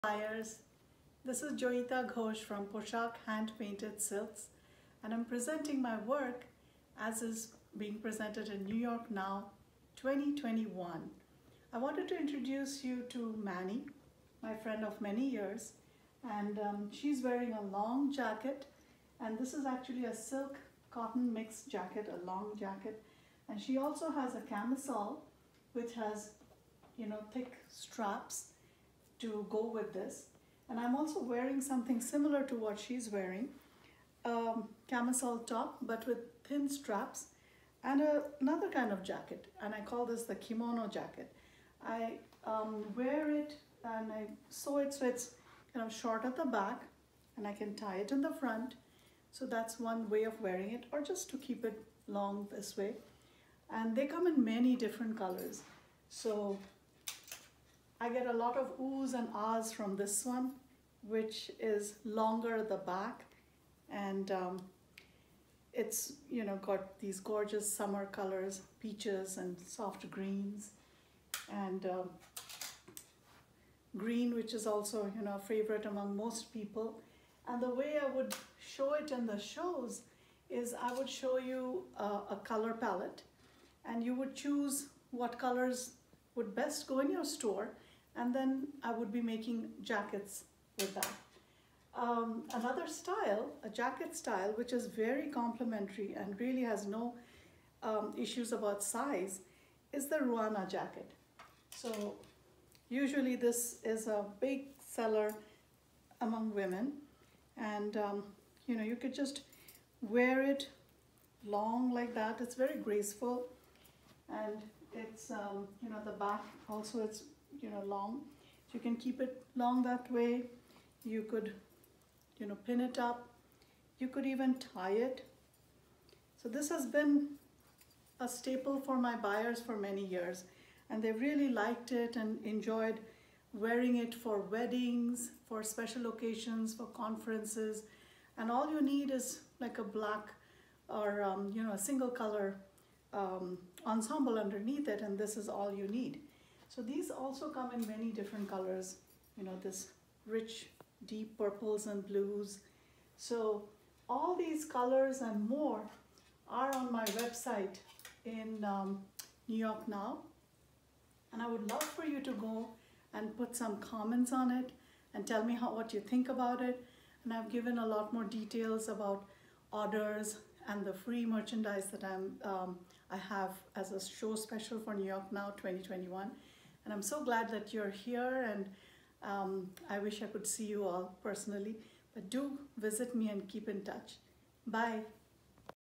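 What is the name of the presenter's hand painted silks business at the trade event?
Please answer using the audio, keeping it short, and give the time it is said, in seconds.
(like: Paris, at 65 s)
Poshaq, at 2 s.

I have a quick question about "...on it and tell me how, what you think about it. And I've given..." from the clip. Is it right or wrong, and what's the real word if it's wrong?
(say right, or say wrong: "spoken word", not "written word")
right.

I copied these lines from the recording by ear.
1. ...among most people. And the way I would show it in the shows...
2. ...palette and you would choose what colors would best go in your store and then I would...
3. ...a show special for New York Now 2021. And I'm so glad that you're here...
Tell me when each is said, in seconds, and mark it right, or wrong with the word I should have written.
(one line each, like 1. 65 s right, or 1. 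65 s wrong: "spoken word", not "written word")
1. 75 s right
2. 82 s right
3. 173 s right.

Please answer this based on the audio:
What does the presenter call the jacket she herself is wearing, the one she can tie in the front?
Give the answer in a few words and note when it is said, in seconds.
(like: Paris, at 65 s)
kimono jacket, at 40 s.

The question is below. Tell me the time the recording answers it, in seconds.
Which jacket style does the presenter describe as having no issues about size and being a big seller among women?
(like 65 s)
100 s.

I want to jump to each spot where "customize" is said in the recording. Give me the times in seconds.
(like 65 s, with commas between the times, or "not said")
not said.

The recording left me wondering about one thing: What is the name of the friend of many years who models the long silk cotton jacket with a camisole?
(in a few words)
Manny.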